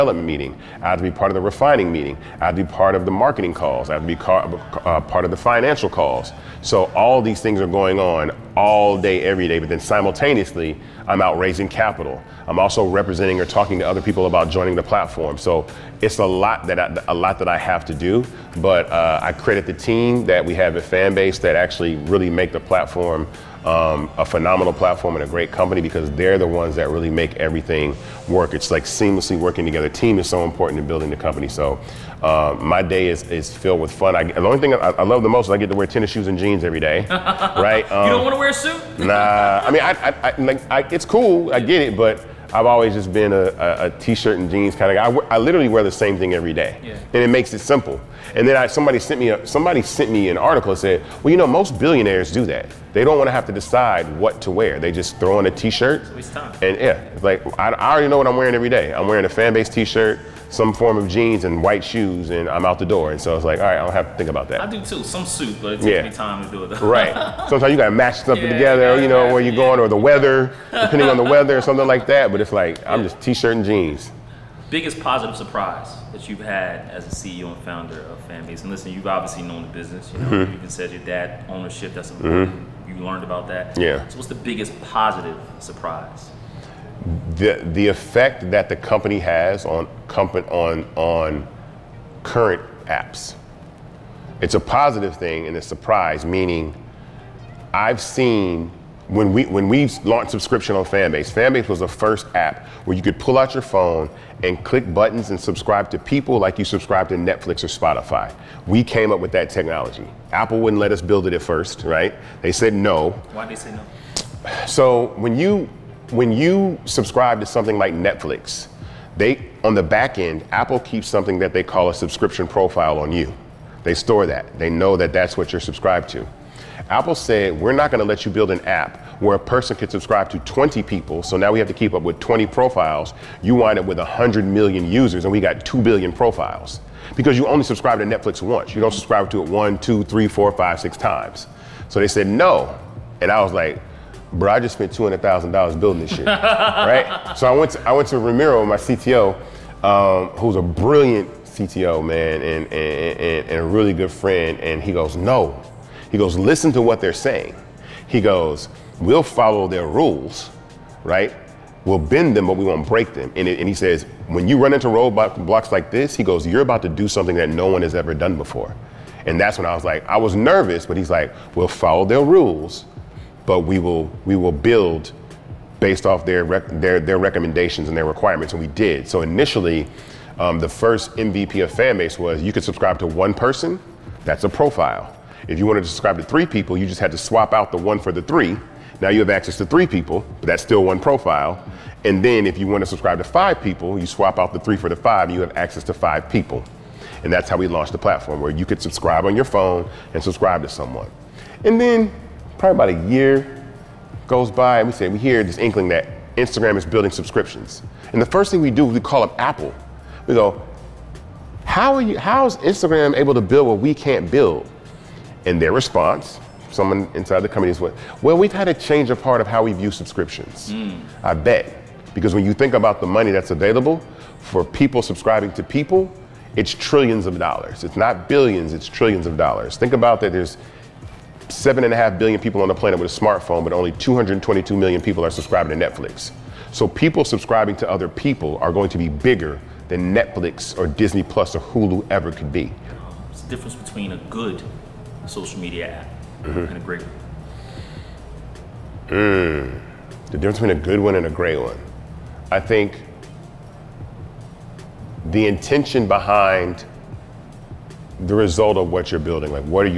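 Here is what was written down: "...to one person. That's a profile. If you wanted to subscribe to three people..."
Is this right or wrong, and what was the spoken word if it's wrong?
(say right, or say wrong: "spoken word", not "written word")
right.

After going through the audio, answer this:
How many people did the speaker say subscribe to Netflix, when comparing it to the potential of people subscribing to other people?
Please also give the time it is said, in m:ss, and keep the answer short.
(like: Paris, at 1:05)
222 million, at 3:53.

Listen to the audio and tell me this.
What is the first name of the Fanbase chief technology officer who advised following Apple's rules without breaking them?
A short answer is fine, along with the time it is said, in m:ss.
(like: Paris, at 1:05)
Ramiro, at 2:28.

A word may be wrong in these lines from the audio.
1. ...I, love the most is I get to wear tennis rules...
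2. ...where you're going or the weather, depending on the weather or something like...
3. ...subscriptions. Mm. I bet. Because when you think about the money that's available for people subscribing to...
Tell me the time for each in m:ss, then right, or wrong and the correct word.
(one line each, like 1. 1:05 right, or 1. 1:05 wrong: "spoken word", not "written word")
1. 0:34 wrong: "shoes", not "rules"
2. 1:09 right
3. 3:39 right.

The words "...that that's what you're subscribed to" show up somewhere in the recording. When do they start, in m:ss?
2:04.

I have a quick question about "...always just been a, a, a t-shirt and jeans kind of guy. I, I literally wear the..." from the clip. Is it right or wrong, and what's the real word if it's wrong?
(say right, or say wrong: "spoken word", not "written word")
right.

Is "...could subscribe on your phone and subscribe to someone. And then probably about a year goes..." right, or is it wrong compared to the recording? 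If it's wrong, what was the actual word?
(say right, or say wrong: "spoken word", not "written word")
right.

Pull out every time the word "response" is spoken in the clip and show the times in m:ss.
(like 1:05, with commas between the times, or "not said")
3:35.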